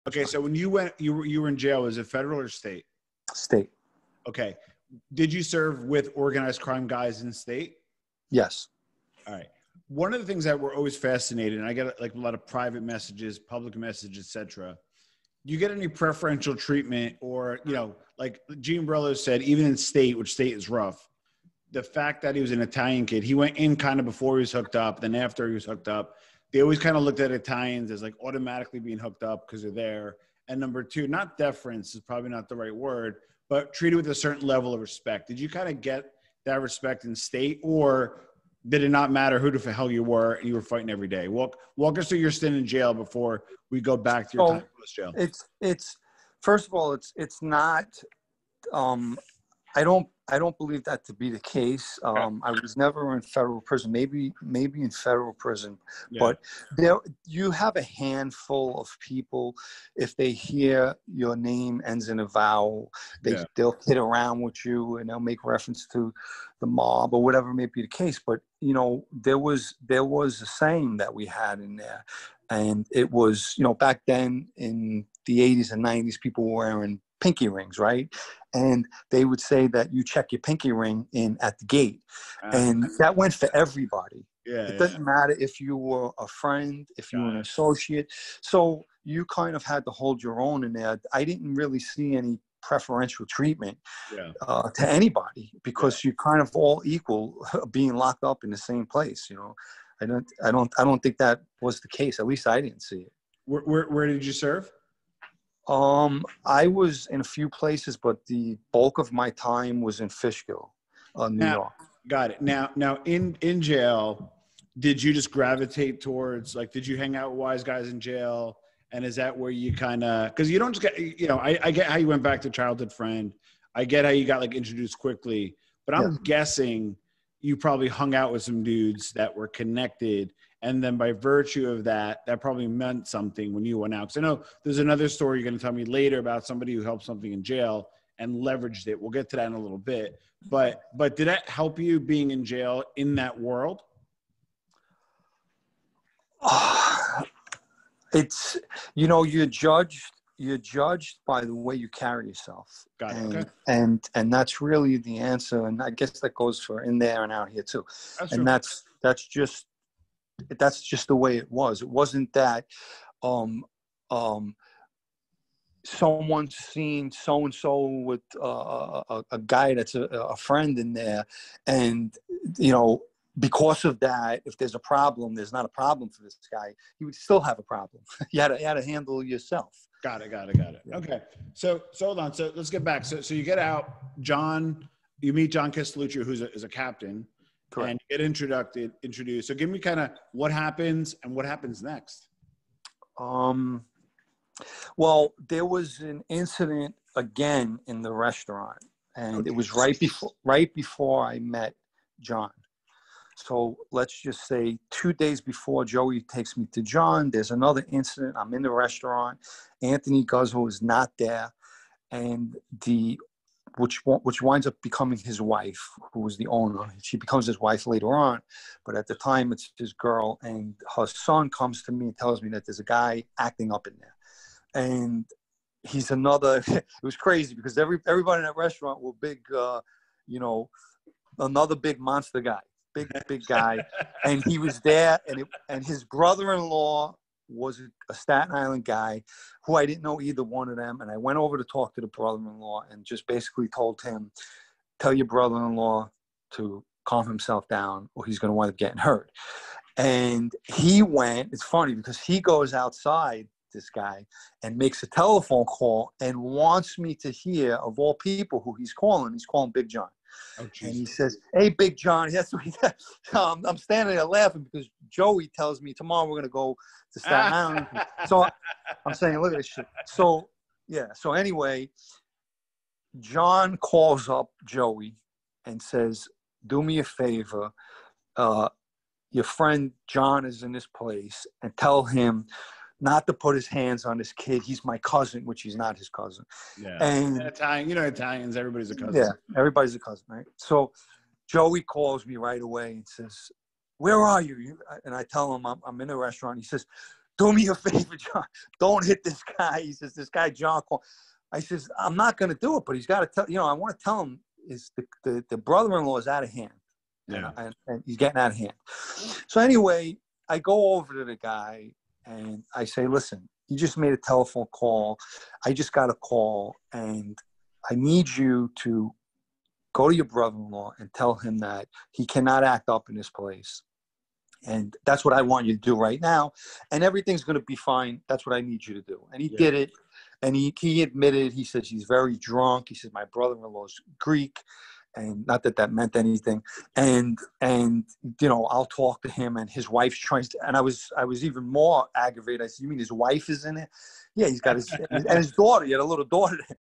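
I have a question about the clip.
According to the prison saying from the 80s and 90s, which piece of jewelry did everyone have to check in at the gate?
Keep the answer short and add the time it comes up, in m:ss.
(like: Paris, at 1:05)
pinky ring, at 1:20.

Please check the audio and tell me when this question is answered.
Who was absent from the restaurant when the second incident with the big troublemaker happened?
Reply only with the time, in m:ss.
3:29.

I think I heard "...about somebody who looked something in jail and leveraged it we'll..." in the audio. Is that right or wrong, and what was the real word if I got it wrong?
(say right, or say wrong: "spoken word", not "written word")
wrong: "helped", not "looked".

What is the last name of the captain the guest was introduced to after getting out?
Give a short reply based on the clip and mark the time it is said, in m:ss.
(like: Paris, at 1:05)
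Castellucci, at 3:05.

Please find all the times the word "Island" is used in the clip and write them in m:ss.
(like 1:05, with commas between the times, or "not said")
3:58, 4:27.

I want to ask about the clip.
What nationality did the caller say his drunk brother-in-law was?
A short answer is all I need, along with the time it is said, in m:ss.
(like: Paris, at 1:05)
Greek, at 5:34.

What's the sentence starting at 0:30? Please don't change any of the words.
And number two, not deference is probably not the right word, but treated with a certain level of respect.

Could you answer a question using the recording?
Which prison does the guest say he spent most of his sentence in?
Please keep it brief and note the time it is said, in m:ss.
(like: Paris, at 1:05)
Fishkill, at 1:50.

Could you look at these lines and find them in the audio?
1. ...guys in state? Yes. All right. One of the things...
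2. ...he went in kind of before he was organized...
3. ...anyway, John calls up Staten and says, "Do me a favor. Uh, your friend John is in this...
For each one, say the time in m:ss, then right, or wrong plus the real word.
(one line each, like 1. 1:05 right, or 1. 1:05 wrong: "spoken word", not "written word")
1. 0:06 right
2. 0:23 wrong: "hooked", not "organized"
3. 4:31 wrong: "Joey", not "Staten".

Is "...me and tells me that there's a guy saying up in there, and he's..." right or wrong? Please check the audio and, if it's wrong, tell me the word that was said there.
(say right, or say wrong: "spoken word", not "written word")
wrong: "acting", not "saying".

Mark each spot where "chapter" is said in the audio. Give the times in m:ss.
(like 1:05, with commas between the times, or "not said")
not said.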